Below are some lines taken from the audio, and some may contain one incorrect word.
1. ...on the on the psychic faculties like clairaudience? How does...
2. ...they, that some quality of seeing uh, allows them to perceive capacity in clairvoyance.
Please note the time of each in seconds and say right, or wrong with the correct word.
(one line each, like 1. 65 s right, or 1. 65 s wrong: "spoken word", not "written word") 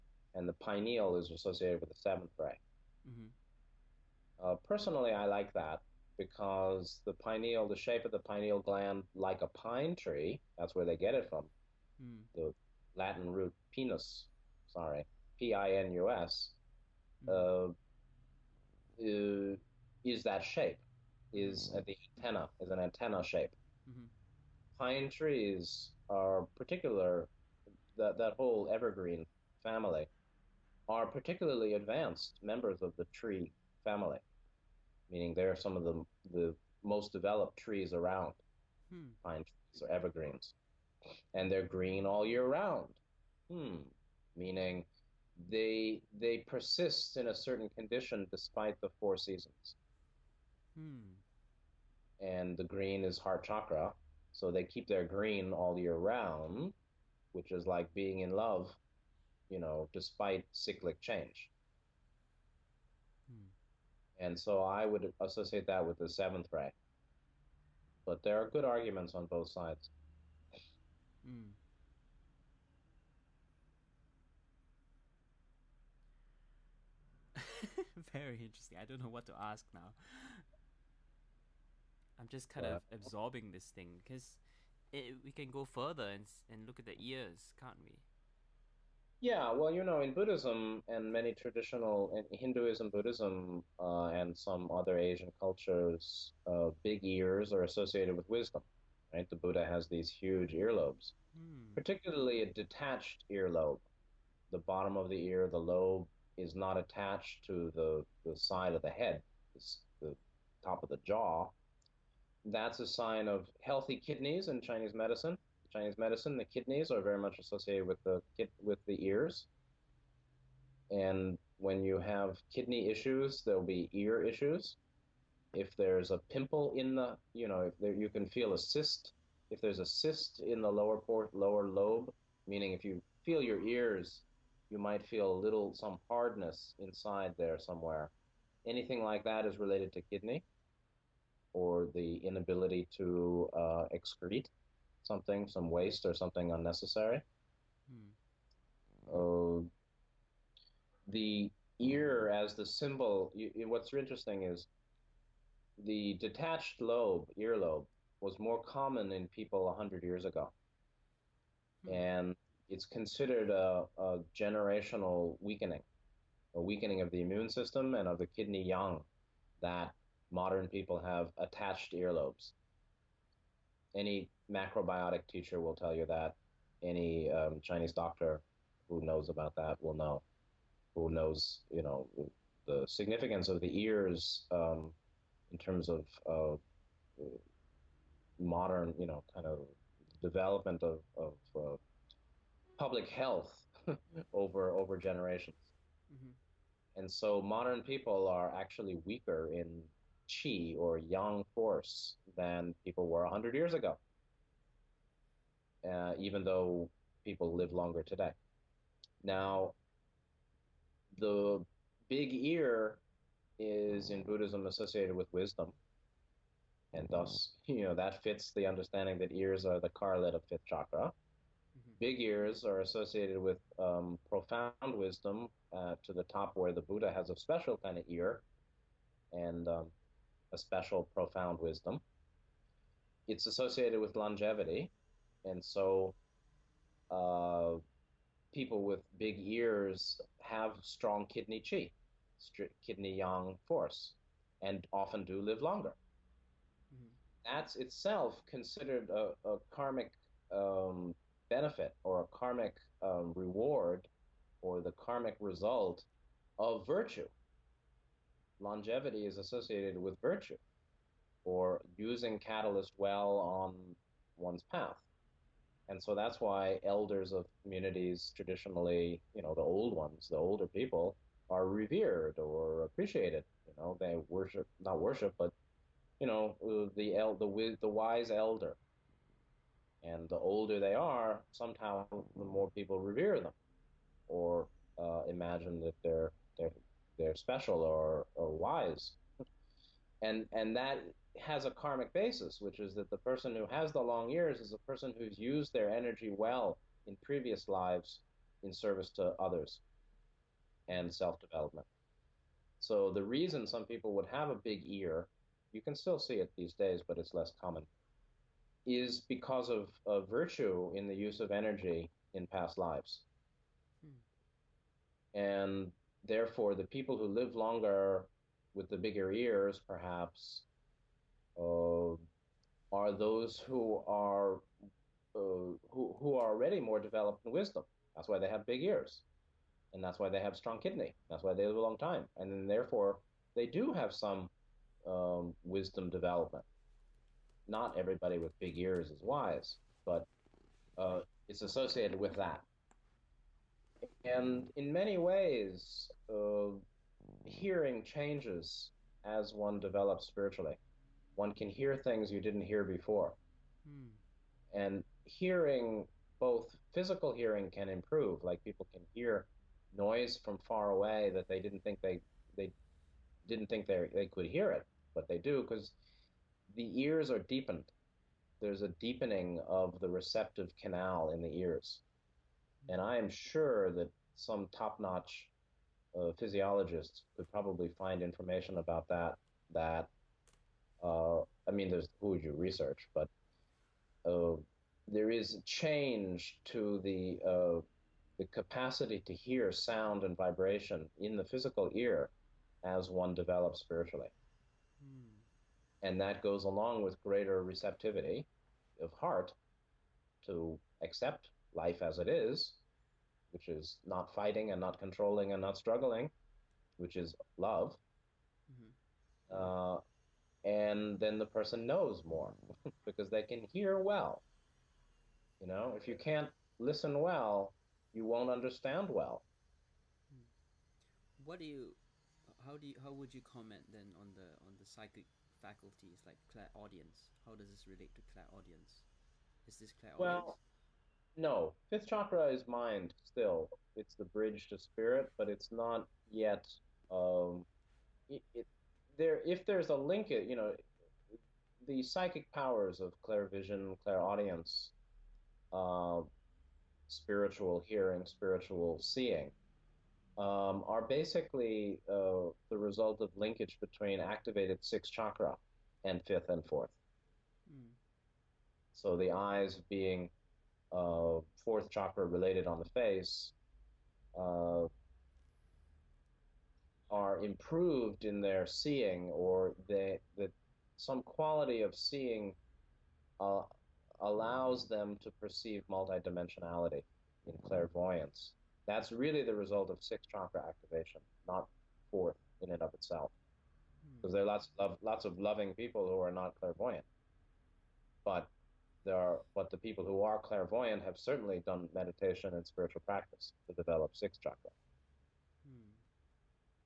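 1. 424 s right
2. 469 s wrong: "multidimensionality", not "capacity".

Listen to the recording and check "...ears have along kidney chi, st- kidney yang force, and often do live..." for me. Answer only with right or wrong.
wrong.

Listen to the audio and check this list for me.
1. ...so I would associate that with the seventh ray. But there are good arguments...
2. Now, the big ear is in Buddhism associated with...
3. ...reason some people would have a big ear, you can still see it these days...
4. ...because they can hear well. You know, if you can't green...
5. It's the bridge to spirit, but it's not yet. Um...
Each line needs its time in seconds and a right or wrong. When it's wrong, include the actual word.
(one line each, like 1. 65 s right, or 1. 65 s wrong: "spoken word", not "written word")
1. 64 s right
2. 209 s right
3. 303 s right
4. 413 s wrong: "listen", not "green"
5. 433 s right.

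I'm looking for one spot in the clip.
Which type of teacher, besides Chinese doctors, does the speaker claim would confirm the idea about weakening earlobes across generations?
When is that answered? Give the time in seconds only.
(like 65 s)
174 s.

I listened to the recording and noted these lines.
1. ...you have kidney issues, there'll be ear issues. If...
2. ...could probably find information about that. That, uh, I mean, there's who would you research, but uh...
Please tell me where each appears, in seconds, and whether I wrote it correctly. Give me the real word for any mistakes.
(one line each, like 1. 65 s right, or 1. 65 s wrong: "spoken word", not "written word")
1. 121 s right
2. 377 s right.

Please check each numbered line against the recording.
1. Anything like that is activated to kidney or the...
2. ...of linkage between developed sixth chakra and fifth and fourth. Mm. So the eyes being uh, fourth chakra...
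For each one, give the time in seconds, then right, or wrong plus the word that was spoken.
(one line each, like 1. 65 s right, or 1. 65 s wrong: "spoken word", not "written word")
1. 138 s wrong: "related", not "activated"
2. 453 s wrong: "activated", not "developed".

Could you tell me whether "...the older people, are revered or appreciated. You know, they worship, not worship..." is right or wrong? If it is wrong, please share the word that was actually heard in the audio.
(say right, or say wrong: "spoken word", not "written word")
right.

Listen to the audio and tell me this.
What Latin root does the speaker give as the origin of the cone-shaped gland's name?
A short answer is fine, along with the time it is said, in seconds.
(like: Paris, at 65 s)
pinus, at 13 s.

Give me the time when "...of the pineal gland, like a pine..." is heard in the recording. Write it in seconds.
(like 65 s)
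8 s.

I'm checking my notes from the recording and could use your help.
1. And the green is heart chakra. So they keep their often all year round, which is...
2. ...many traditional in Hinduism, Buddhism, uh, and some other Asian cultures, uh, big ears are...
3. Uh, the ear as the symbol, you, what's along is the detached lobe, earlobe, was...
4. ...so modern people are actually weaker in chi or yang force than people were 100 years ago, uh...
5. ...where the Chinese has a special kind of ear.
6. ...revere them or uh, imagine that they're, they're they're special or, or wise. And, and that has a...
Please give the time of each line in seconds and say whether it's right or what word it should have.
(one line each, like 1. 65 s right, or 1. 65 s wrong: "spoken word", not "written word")
1. 52 s wrong: "green", not "often"
2. 91 s right
3. 149 s wrong: "interesting", not "along"
4. 197 s right
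5. 226 s wrong: "Buddha", not "Chinese"
6. 283 s right.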